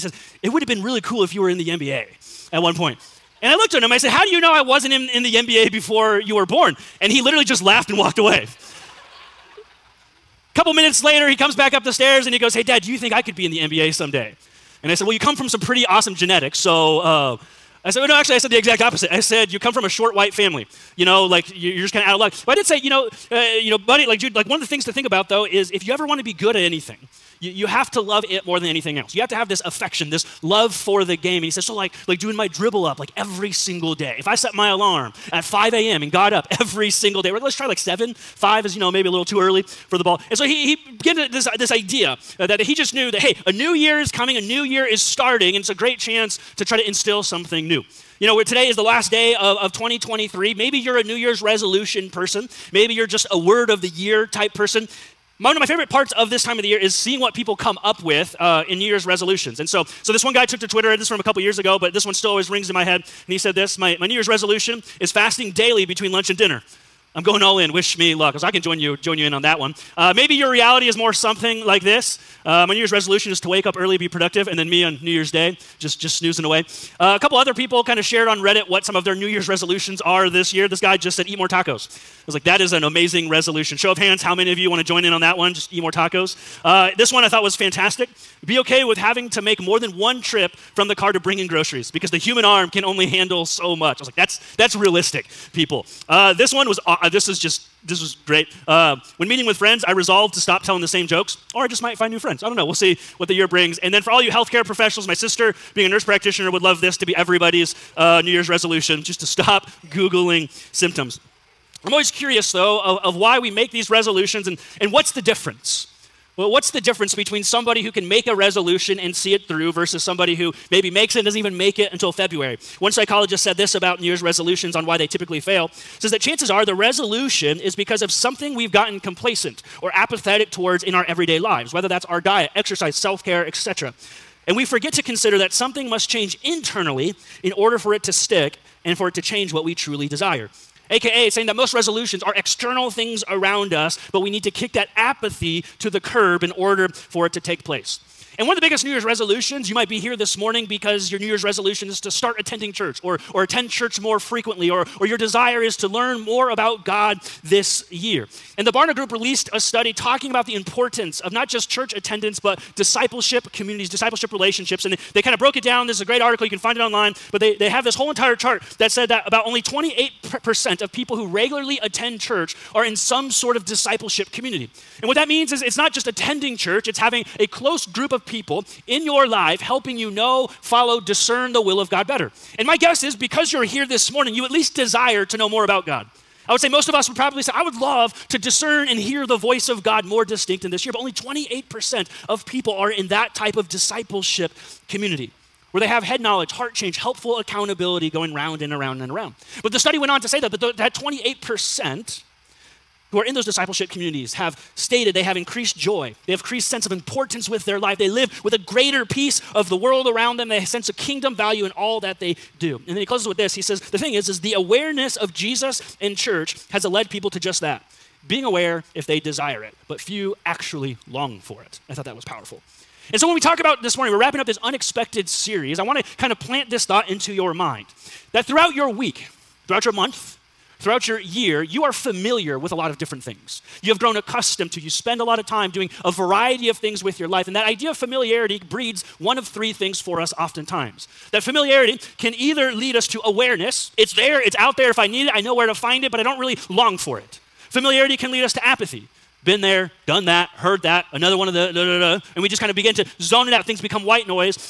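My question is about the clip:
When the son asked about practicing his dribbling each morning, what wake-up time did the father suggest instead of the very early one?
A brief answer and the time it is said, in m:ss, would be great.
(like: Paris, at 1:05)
7, at 0:37.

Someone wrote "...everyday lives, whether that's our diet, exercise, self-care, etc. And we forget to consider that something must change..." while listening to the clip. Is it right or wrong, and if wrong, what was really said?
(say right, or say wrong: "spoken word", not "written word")
right.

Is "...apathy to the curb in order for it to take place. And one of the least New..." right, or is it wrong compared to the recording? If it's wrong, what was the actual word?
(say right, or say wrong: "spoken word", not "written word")
wrong: "biggest", not "least".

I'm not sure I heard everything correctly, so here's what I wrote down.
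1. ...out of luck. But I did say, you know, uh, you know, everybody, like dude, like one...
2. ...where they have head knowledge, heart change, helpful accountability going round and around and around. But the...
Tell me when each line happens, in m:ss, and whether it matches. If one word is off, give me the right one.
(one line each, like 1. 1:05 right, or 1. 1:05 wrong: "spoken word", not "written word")
1. 0:22 wrong: "buddy", not "everybody"
2. 3:15 right.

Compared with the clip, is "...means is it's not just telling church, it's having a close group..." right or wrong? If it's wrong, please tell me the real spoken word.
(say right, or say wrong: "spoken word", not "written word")
wrong: "attending", not "telling".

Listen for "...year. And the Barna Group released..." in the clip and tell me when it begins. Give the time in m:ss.
2:37.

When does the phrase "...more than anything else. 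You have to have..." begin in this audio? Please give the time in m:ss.
0:28.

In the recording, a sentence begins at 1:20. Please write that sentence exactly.
This guy just said, eat more tacos.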